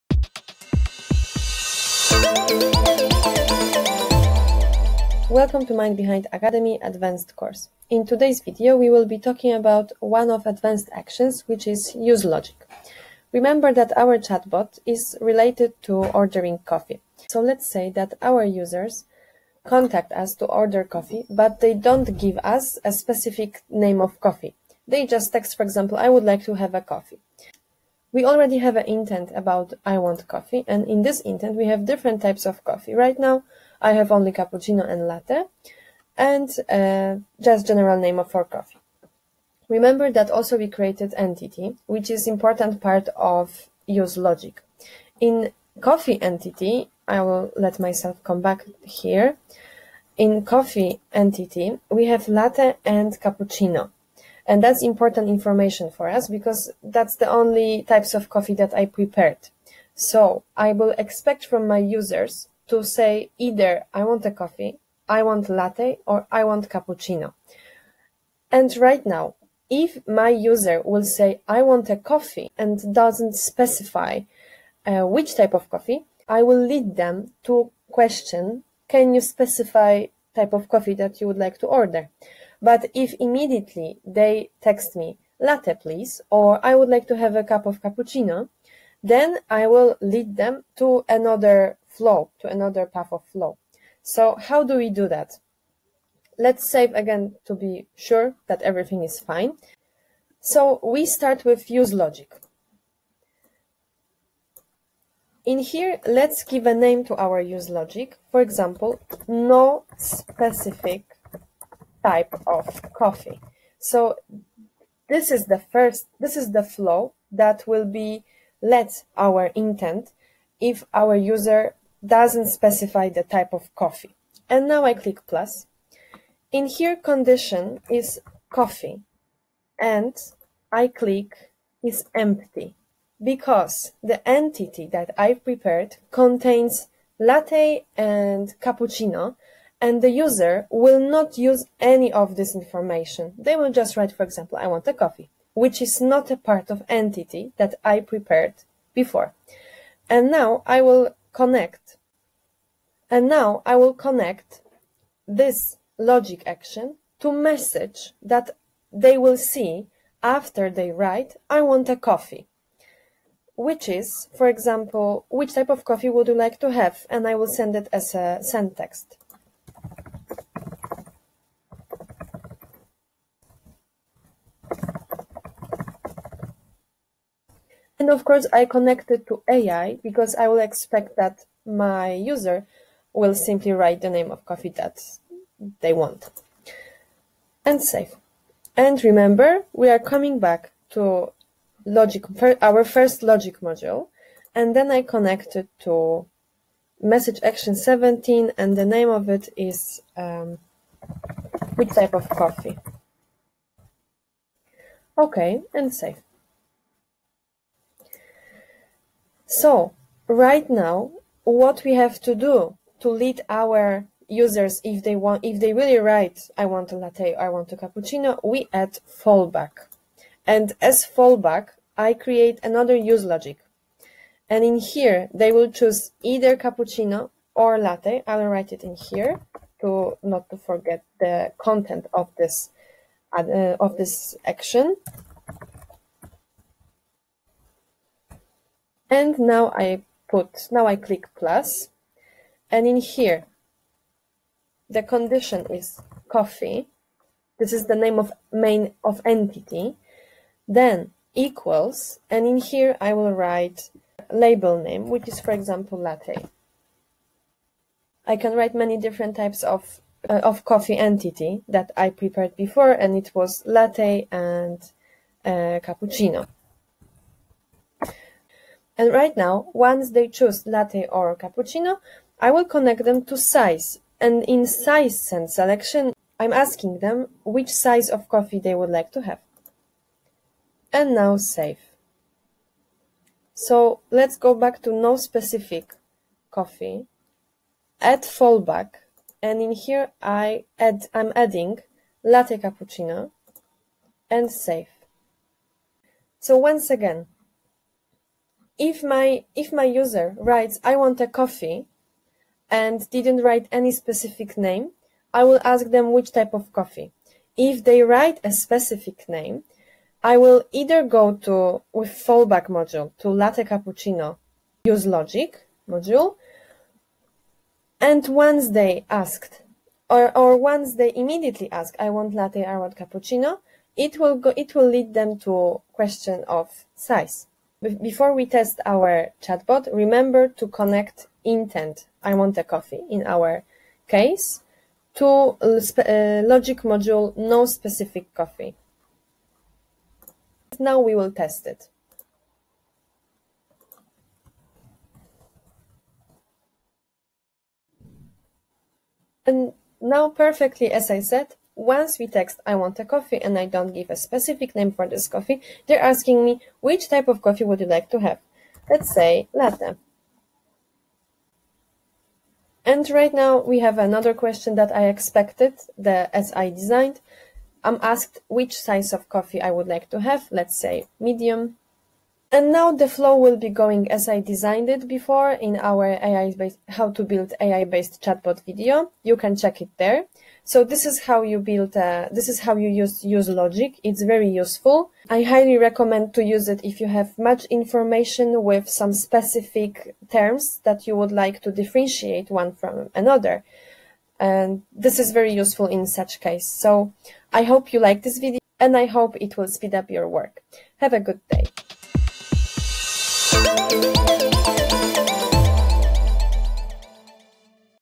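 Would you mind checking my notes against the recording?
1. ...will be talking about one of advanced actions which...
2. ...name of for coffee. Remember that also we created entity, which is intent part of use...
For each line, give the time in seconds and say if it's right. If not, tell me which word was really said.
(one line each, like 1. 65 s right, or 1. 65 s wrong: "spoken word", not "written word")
1. 8 s right
2. 37 s wrong: "important", not "intent".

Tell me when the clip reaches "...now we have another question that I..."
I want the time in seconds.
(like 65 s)
363 s.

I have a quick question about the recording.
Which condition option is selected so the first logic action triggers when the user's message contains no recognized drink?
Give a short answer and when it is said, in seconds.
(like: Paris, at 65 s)
is empty, at 131 s.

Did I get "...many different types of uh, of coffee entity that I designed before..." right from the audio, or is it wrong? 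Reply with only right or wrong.
wrong.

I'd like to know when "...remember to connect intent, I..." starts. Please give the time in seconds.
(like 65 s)
329 s.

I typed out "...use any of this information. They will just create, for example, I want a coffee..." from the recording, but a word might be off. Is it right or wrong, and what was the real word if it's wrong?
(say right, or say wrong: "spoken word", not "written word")
wrong: "write", not "create".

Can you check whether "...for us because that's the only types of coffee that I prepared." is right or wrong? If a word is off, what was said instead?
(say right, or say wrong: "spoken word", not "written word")
right.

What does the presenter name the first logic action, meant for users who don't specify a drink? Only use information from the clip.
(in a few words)
No specific type of coffee.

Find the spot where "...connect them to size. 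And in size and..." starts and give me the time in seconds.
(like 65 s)
272 s.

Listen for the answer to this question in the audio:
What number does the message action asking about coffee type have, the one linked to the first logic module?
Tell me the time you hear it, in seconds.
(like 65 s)
197 s.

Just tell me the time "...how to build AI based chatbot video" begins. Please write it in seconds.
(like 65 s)
376 s.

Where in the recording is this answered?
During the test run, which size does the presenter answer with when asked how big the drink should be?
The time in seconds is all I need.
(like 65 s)
371 s.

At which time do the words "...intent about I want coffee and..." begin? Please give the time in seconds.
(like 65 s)
28 s.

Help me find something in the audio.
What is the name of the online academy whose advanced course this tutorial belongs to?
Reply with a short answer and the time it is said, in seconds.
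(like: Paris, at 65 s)
Mind Behind Academy, at 5 s.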